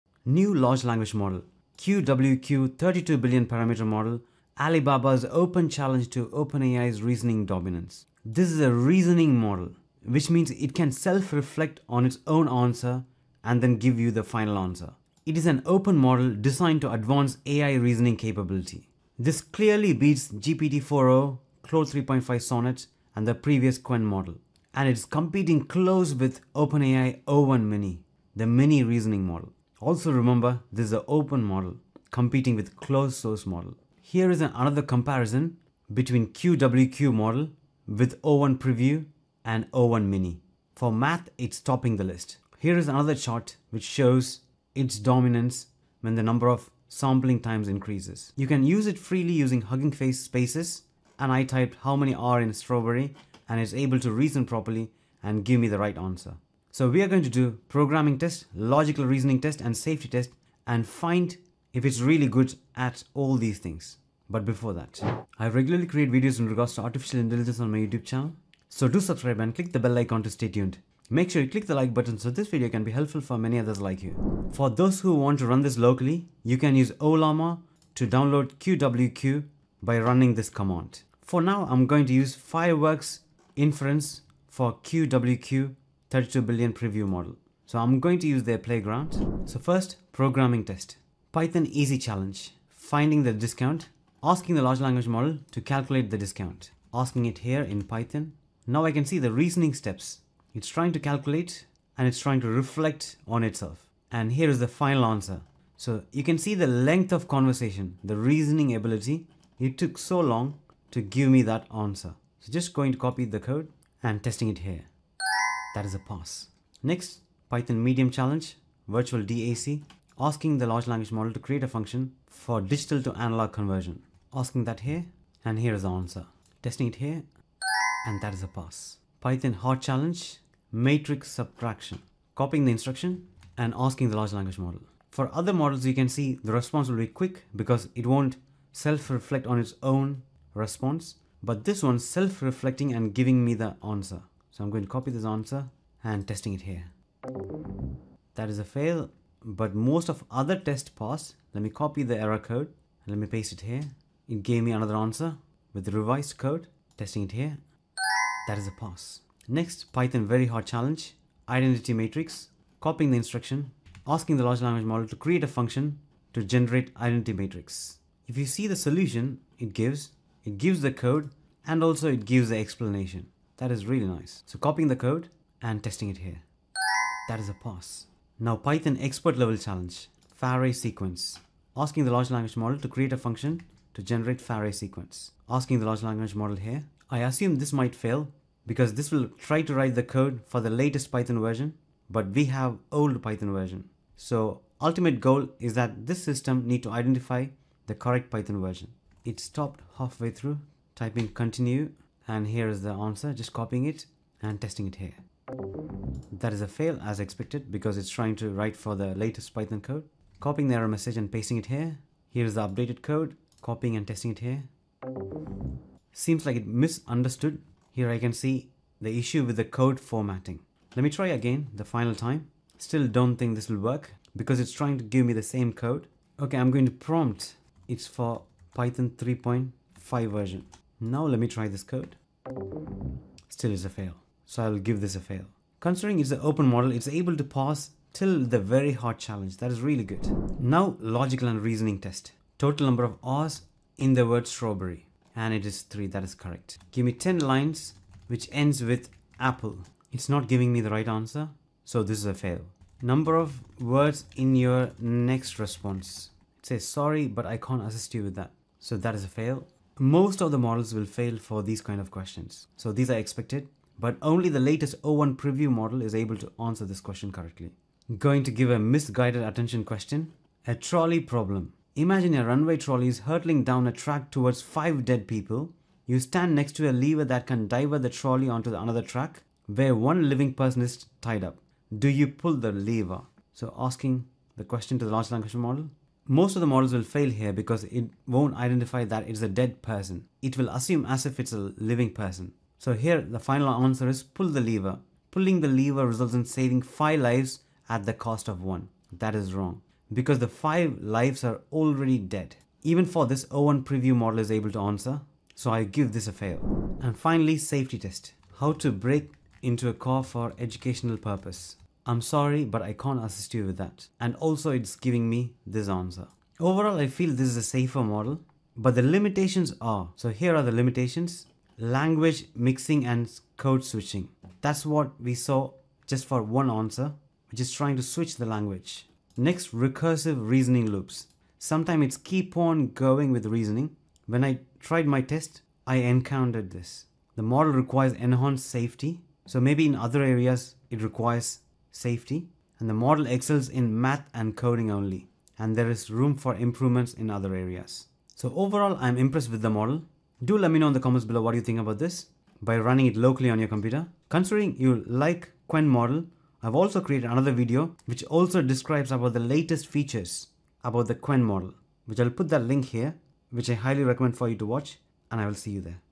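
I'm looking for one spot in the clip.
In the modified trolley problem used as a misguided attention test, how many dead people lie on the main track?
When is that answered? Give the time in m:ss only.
4:34.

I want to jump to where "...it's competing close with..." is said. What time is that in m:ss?
0:24.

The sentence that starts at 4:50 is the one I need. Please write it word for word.
It will assume as if it's a living person.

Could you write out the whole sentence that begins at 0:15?
It is an open model designed to advance AI reasoning capability.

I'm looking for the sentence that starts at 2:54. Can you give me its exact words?
So copying the code and testing it here.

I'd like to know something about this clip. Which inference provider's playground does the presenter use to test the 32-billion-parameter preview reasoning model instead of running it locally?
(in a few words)
Fireworks.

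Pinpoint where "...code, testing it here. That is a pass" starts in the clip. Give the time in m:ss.
2:36.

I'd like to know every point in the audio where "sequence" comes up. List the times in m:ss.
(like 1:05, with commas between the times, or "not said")
3:00, 3:04.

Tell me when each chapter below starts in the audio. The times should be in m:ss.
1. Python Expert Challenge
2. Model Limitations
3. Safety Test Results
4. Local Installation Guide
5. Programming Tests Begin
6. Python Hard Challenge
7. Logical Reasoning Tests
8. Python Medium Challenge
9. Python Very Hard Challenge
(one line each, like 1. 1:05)
1. 2:59
2. 5:16
3. 4:28
4. 1:15
5. 1:30
6. 2:10
7. 4:01
8. 1:58
9. 2:39.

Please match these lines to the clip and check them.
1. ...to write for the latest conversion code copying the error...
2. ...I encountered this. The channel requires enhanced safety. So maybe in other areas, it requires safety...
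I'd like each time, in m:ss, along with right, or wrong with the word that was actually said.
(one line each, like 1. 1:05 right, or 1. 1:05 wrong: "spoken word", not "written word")
1. 3:28 wrong: "python", not "conversion"
2. 5:35 wrong: "model", not "channel".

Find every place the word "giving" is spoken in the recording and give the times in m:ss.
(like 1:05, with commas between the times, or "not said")
2:23, 4:10, 5:14.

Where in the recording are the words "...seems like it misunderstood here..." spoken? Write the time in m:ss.
3:36.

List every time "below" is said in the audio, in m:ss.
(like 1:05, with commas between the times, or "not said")
5:51.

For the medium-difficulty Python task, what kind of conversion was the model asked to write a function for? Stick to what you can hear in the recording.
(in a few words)
Digital to analog conversion.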